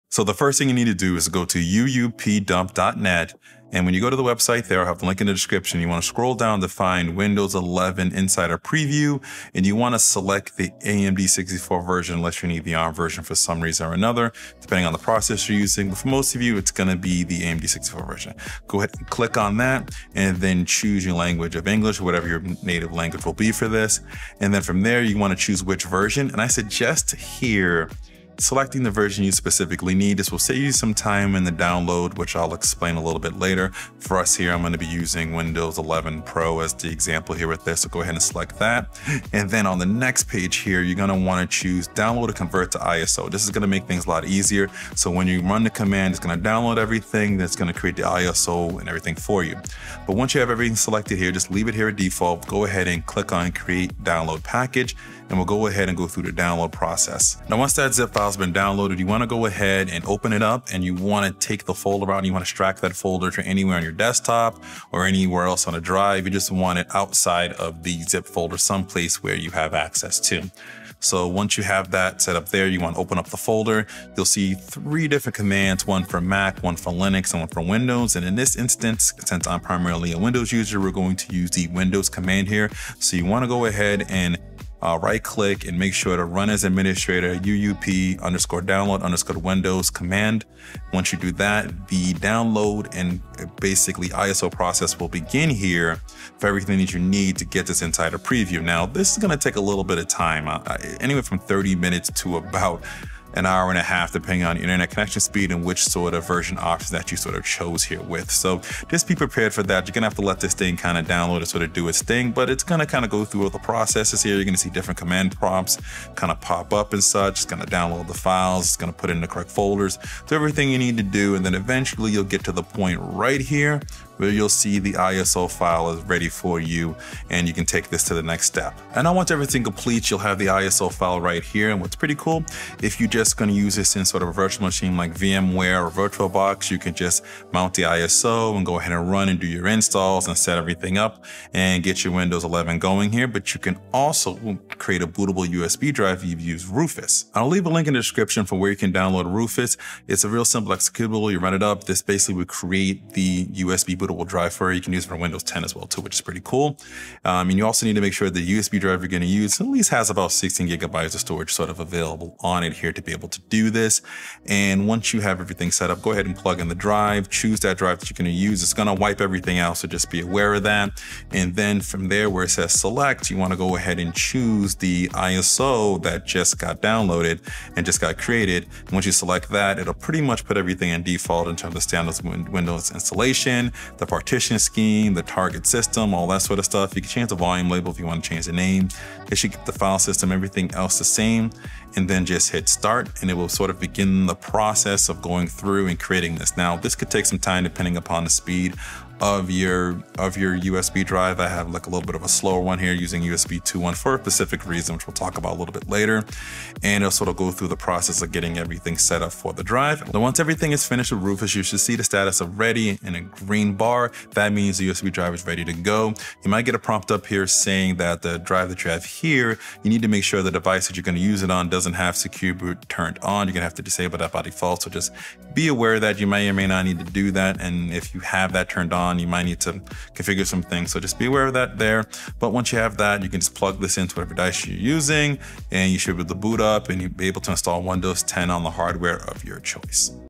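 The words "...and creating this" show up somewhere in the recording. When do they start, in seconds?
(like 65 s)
195 s.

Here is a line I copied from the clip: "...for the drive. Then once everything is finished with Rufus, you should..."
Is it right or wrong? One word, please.
right.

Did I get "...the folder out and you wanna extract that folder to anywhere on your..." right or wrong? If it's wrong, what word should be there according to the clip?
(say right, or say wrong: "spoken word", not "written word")
right.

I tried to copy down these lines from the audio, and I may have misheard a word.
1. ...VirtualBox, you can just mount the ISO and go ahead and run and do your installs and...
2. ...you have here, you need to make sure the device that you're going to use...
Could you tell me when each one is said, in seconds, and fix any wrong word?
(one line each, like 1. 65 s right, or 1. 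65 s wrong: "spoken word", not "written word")
1. 135 s right
2. 218 s right.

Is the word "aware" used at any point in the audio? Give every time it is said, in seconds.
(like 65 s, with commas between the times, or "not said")
170 s, 225 s, 231 s.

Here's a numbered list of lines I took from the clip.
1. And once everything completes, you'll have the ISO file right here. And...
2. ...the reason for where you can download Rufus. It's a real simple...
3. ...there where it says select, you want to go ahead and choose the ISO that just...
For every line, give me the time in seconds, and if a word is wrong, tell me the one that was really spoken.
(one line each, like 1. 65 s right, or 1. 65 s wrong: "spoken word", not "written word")
1. 128 s right
2. 147 s wrong: "description", not "reason"
3. 172 s right.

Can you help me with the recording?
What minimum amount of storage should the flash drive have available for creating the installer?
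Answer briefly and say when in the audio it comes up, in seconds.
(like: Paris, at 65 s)
16 gigabytes, at 160 s.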